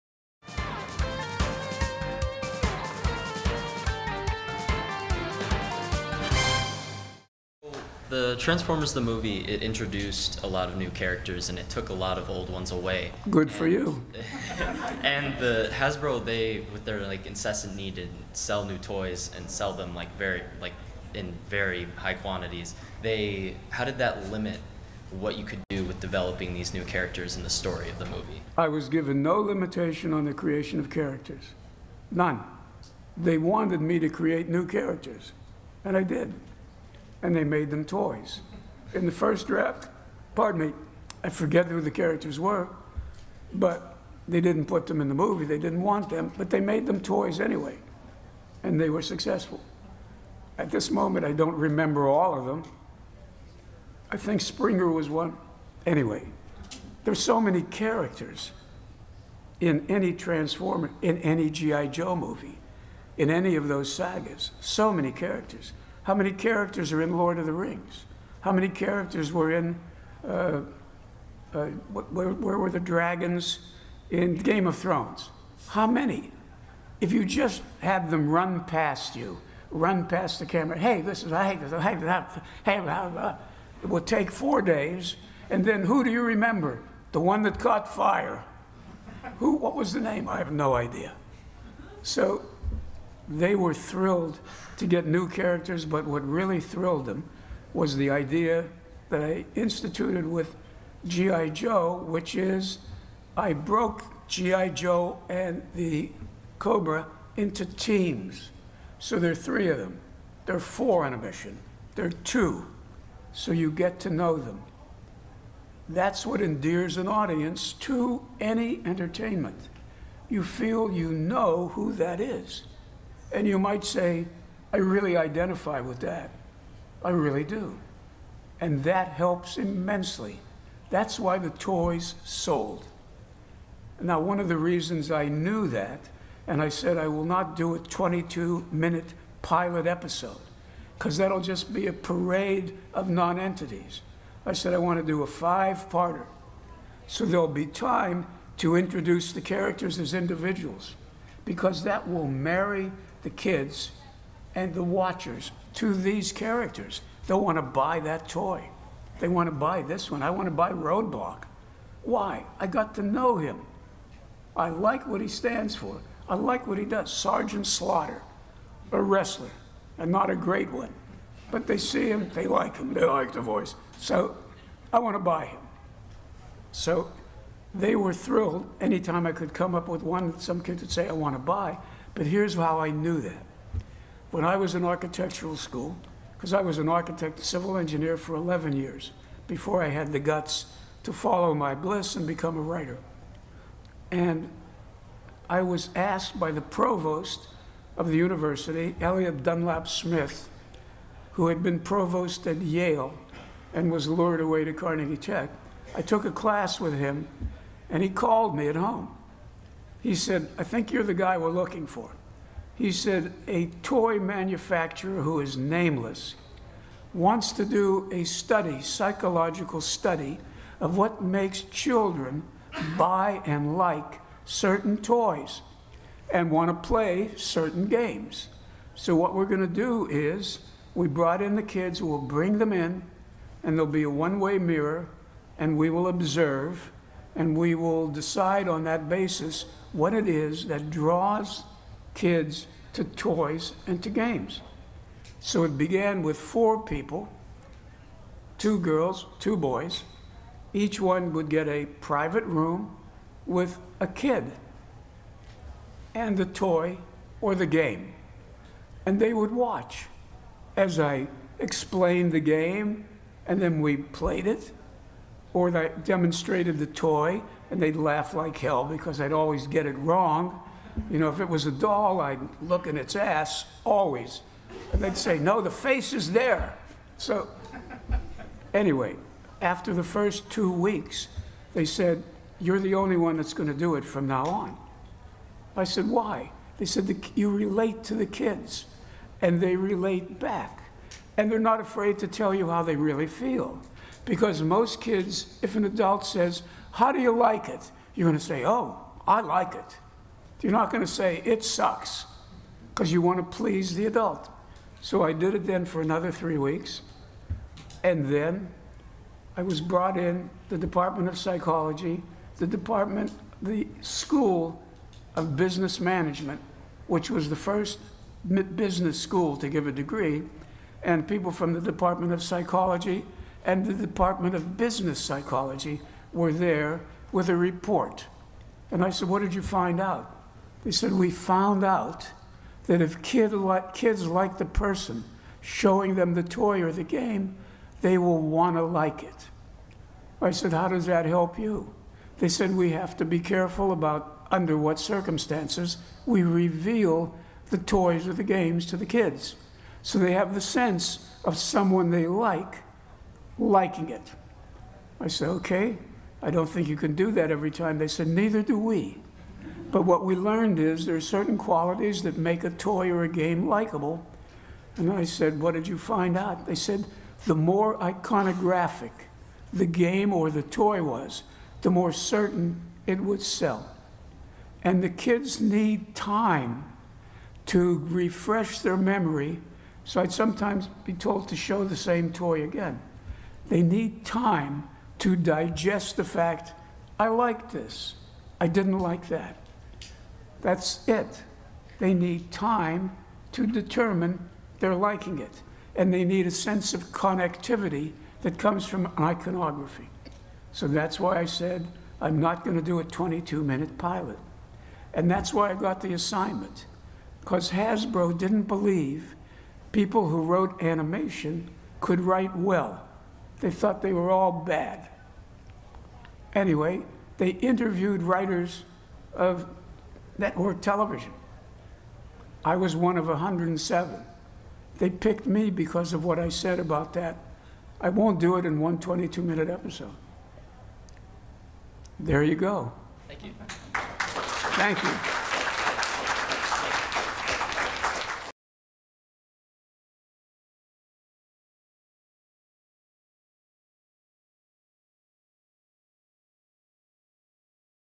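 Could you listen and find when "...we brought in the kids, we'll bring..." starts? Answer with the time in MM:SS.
03:50.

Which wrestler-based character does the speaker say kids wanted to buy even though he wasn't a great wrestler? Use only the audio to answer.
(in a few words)
Sergeant Slaughter.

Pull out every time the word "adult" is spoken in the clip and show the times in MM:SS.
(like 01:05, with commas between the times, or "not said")
04:55, 05:04.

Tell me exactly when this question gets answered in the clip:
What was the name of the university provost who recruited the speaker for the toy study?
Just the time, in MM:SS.
03:19.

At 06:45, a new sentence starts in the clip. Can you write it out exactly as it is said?
And that's why I got the assignment, because Hasbro didn't believe people who wrote animation could write well.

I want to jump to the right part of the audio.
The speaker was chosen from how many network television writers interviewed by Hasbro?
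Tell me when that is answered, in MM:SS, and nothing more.
07:03.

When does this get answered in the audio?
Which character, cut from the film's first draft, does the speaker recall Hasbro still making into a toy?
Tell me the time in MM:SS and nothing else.
00:54.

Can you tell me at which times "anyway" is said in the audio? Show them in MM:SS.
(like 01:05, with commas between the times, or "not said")
00:47, 00:55, 04:38, 06:56.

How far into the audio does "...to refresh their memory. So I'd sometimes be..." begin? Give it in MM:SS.
06:17.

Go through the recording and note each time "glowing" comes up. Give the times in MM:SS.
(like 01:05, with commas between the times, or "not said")
not said.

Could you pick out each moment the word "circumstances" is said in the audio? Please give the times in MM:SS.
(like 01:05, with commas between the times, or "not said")
05:44.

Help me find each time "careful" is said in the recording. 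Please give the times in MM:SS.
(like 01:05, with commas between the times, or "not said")
05:43.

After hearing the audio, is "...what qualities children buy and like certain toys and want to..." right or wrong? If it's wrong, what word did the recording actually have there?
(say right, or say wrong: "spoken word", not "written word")
wrong: "makes", not "qualities".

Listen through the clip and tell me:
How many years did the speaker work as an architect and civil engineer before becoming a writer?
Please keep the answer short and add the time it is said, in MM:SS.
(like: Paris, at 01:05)
11, at 03:08.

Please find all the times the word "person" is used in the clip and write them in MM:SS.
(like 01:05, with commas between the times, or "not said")
05:34.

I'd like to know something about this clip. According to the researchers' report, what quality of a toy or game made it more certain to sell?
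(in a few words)
Iconographic.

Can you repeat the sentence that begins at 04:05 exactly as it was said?
So it began with four people, two girls, two boys.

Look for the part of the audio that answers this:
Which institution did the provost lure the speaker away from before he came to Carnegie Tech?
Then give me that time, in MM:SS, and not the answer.
03:22.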